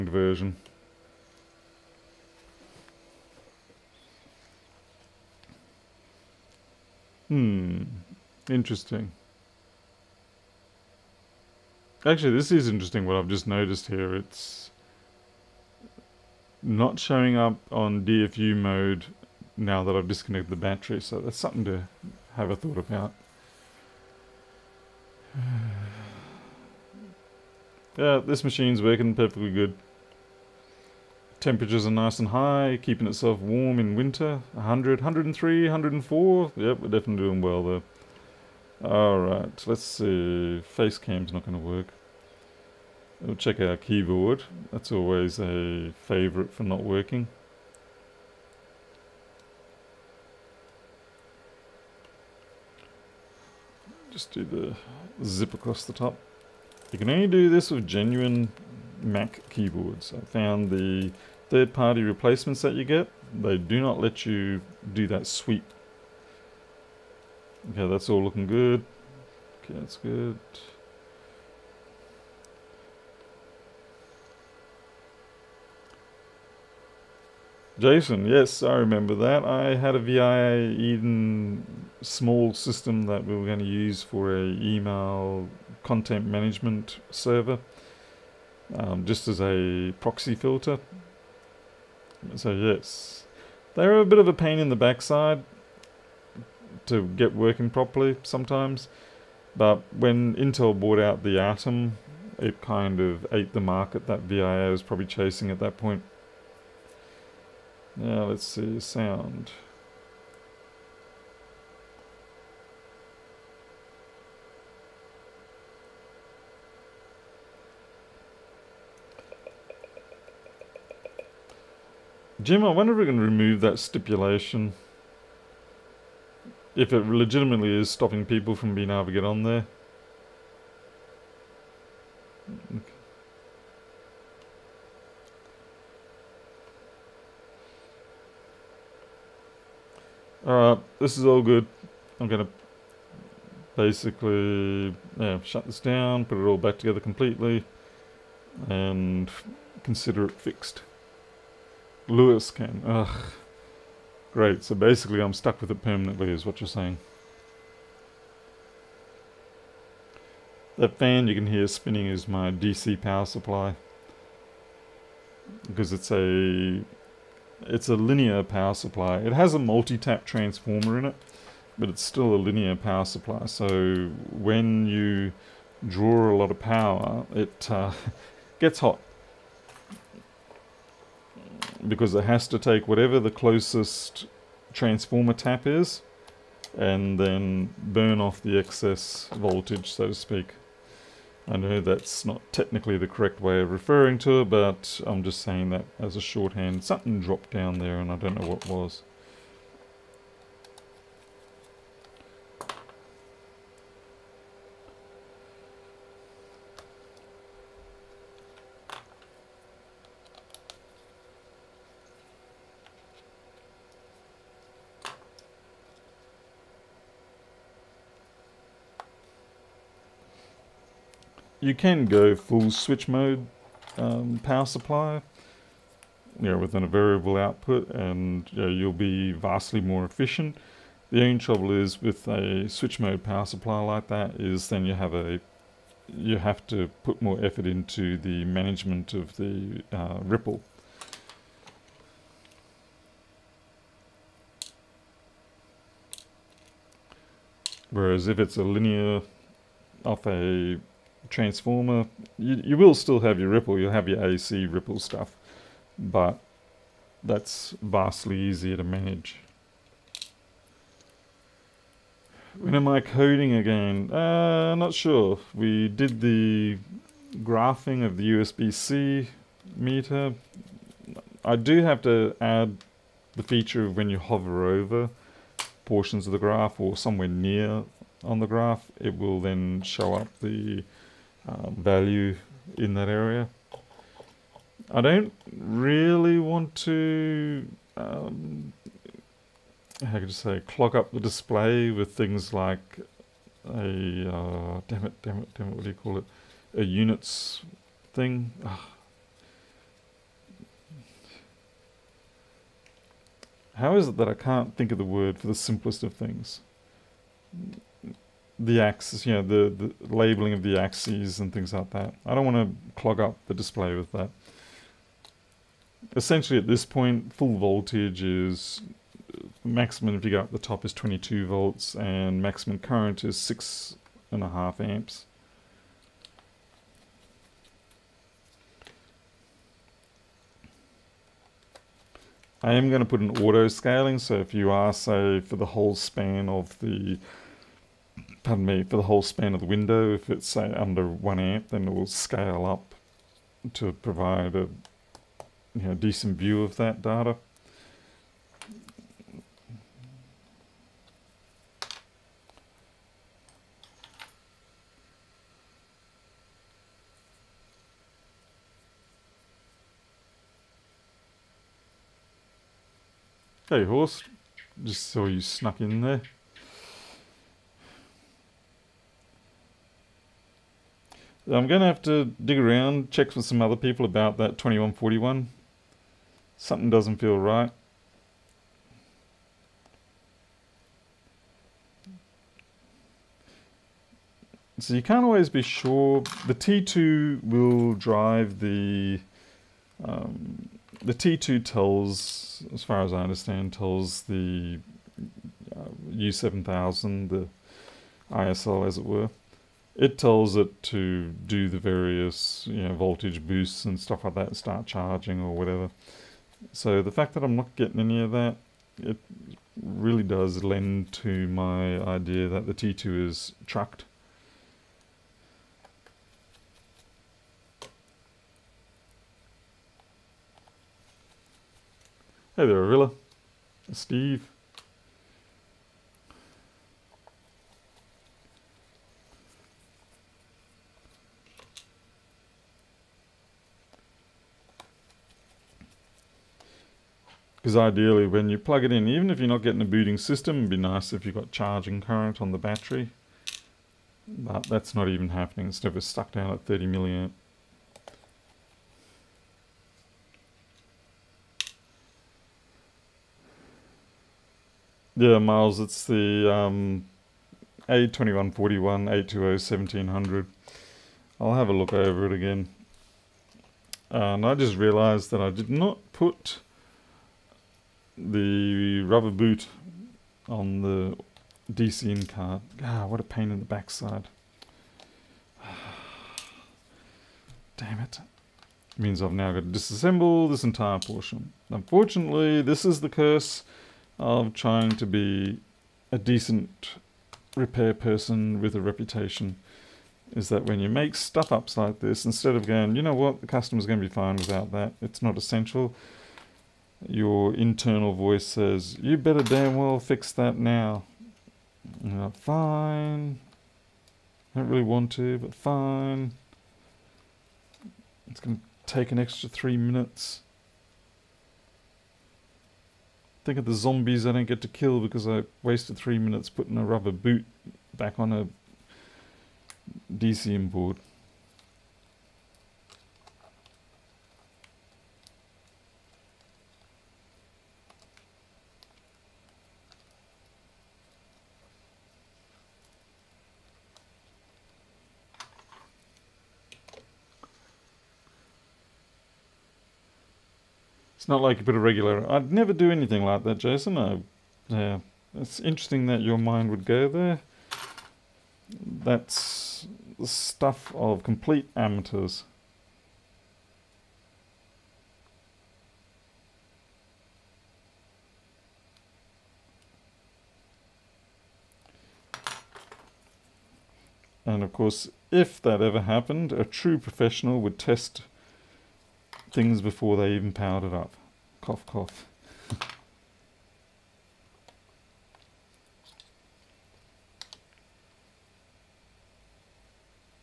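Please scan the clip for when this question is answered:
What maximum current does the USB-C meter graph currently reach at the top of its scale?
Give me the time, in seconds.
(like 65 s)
323 s.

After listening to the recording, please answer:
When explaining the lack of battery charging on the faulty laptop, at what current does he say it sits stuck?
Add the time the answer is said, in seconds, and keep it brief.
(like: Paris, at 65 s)
30 milliamps, at 446 s.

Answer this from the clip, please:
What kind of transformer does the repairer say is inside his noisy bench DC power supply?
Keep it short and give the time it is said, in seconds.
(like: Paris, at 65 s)
multi-tap, at 169 s.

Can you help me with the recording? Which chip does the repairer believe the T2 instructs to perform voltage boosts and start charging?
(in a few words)
U7000.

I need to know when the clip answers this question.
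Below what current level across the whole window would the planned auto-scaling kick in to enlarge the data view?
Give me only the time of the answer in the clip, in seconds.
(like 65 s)
341 s.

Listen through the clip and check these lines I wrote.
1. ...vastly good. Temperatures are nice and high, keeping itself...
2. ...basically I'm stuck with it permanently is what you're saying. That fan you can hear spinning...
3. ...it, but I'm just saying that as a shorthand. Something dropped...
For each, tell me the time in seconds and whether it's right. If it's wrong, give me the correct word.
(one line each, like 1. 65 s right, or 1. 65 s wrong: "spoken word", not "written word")
1. 29 s wrong: "perfectly", not "vastly"
2. 154 s right
3. 194 s right.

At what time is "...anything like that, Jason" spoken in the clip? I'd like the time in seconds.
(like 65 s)
542 s.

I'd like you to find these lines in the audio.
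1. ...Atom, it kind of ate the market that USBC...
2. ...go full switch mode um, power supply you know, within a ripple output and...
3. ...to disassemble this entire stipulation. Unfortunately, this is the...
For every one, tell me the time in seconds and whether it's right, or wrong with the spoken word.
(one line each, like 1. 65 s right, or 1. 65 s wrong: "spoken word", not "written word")
1. 101 s wrong: "VIA", not "USBC"
2. 222 s wrong: "variable", not "ripple"
3. 479 s wrong: "portion", not "stipulation".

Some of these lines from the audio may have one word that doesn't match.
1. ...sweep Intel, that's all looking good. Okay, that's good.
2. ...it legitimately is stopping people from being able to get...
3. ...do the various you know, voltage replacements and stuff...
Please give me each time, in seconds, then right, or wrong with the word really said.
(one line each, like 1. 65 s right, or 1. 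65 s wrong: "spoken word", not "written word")
1. 65 s wrong: "Okay", not "Intel"
2. 126 s right
3. 401 s wrong: "boosts", not "replacements".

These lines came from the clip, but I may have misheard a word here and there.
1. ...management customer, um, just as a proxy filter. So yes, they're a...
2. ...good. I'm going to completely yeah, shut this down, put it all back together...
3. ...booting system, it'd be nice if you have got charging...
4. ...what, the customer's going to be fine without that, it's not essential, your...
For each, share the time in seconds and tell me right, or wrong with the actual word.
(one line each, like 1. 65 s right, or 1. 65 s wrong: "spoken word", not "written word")
1. 86 s wrong: "server", not "customer"
2. 141 s wrong: "basically", not "completely"
3. 439 s right
4. 493 s right.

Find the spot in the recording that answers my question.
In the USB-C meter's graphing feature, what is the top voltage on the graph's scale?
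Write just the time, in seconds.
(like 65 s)
320 s.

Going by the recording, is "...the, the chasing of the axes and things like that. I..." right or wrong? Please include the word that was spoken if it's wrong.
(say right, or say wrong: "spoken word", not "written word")
wrong: "labeling", not "chasing".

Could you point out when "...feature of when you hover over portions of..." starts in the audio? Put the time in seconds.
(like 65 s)
273 s.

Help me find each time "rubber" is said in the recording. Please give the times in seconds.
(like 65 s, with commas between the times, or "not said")
469 s, 516 s.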